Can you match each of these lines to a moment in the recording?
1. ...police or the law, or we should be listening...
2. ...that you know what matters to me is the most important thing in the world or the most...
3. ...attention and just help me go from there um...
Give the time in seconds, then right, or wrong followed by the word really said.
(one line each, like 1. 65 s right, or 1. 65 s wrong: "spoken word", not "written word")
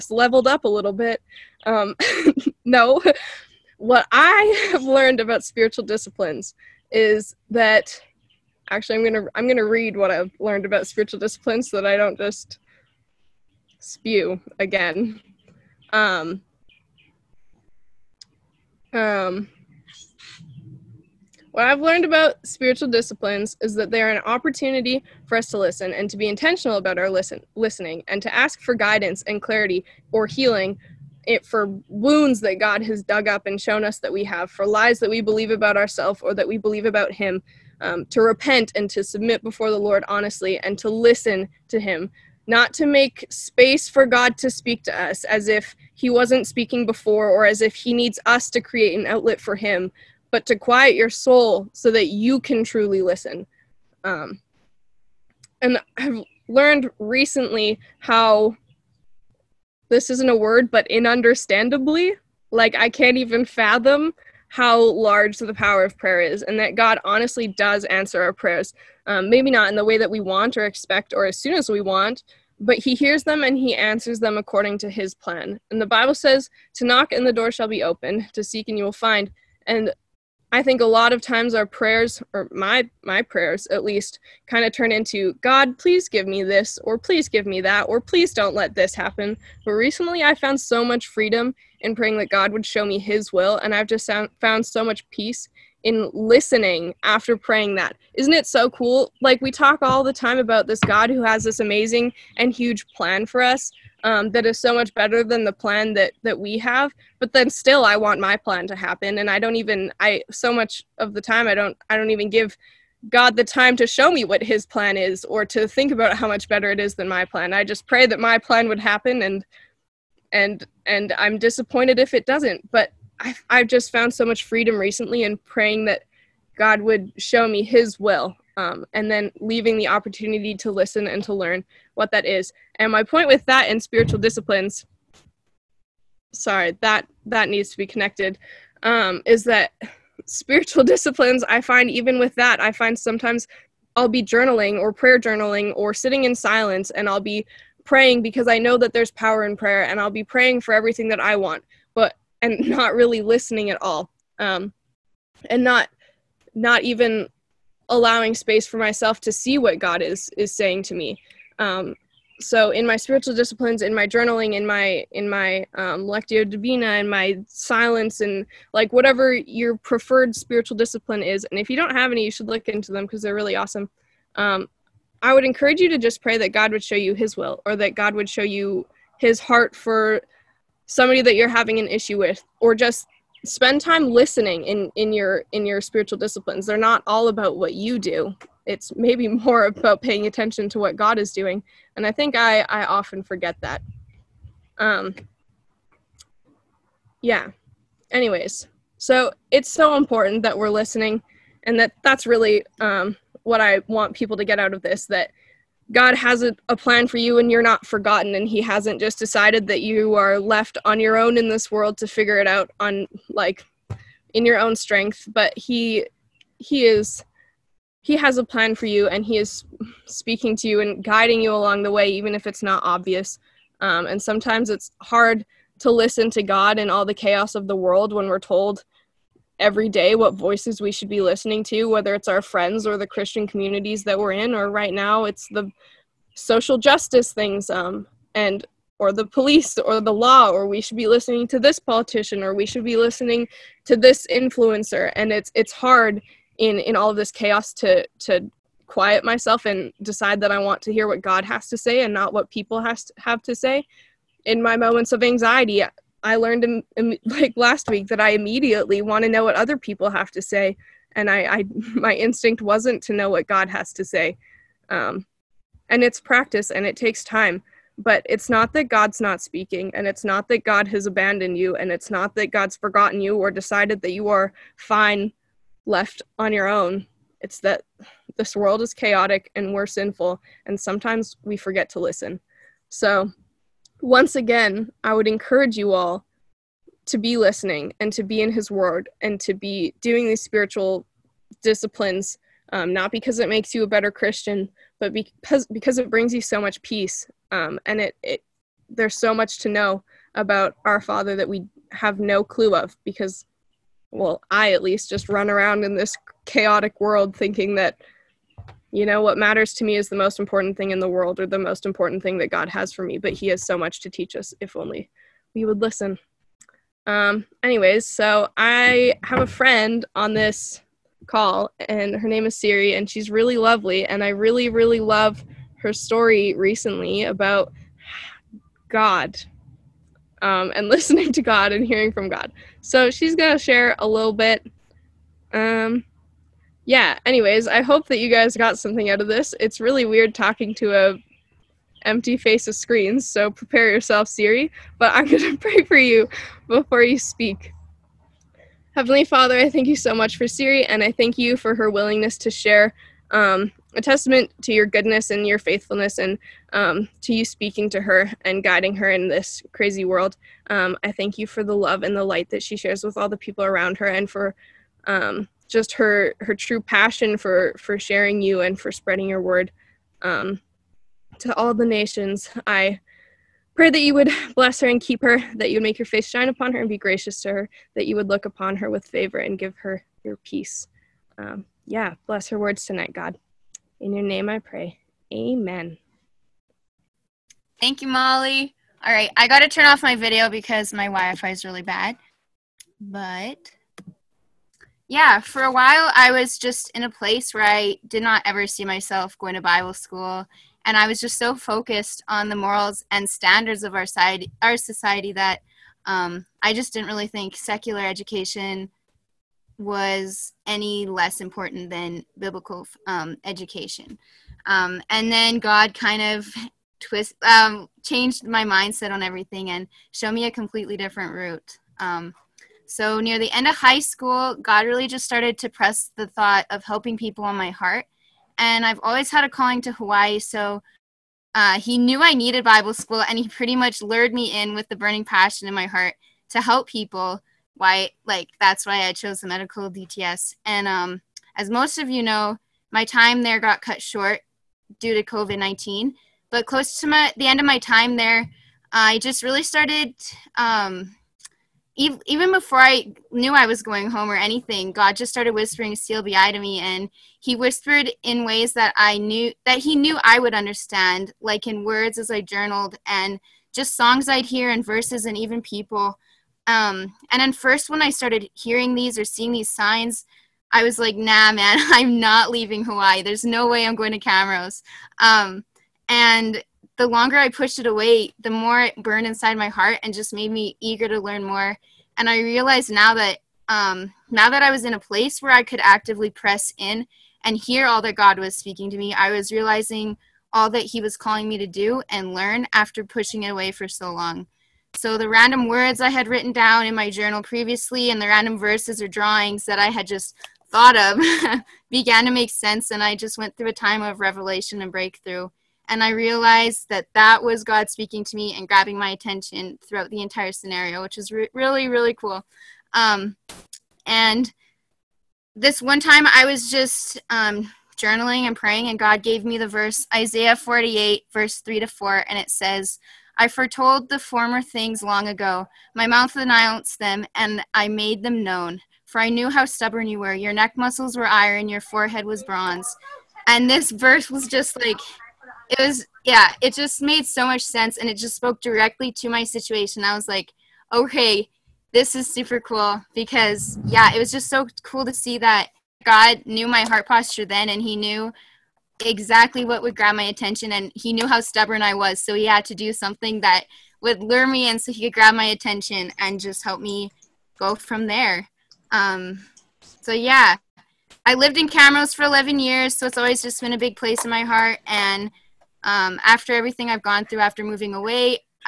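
1. 239 s right
2. 307 s right
3. 555 s right.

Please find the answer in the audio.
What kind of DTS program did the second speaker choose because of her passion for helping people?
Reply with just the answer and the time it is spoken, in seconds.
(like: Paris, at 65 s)
medical DTS, at 439 s.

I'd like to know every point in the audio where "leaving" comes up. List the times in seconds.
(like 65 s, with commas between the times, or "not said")
129 s, 472 s.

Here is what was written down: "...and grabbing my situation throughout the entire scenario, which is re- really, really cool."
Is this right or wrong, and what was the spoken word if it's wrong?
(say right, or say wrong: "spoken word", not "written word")
wrong: "attention", not "situation".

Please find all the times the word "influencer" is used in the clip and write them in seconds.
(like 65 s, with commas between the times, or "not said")
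244 s.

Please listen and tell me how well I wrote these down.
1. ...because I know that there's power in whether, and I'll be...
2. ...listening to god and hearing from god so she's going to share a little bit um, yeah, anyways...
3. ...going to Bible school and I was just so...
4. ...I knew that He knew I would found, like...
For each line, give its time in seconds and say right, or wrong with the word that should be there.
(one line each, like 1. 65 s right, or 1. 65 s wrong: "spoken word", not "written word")
1. 148 s wrong: "prayer", not "whether"
2. 330 s right
3. 399 s right
4. 458 s wrong: "understand", not "found".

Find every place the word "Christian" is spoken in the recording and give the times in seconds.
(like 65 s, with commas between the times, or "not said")
233 s, 294 s.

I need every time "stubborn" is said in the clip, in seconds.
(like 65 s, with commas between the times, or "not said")
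529 s, 551 s.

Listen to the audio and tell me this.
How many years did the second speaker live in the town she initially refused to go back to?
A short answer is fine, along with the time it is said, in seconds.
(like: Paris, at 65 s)
11, at 562 s.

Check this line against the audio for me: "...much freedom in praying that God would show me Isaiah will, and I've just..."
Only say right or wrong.
wrong.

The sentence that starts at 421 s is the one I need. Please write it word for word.
Um, so, near the end of high school, God really just started to press the thought of helping people on my heart.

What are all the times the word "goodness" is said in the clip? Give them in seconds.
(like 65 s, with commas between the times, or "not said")
354 s.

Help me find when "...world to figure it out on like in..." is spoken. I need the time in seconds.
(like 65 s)
211 s.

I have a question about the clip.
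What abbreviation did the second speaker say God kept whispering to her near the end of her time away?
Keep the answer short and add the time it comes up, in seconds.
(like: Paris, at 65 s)
CLBI, at 455 s.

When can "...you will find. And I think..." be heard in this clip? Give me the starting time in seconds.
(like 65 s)
78 s.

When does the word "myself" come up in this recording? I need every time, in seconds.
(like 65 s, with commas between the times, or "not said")
158 s, 249 s, 398 s.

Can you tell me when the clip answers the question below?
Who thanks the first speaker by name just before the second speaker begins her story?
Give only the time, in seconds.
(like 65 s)
388 s.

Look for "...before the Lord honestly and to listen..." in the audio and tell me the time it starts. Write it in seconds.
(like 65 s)
39 s.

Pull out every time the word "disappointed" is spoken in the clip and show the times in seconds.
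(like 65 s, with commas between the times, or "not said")
121 s.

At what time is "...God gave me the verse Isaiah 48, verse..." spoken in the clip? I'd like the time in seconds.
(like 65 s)
518 s.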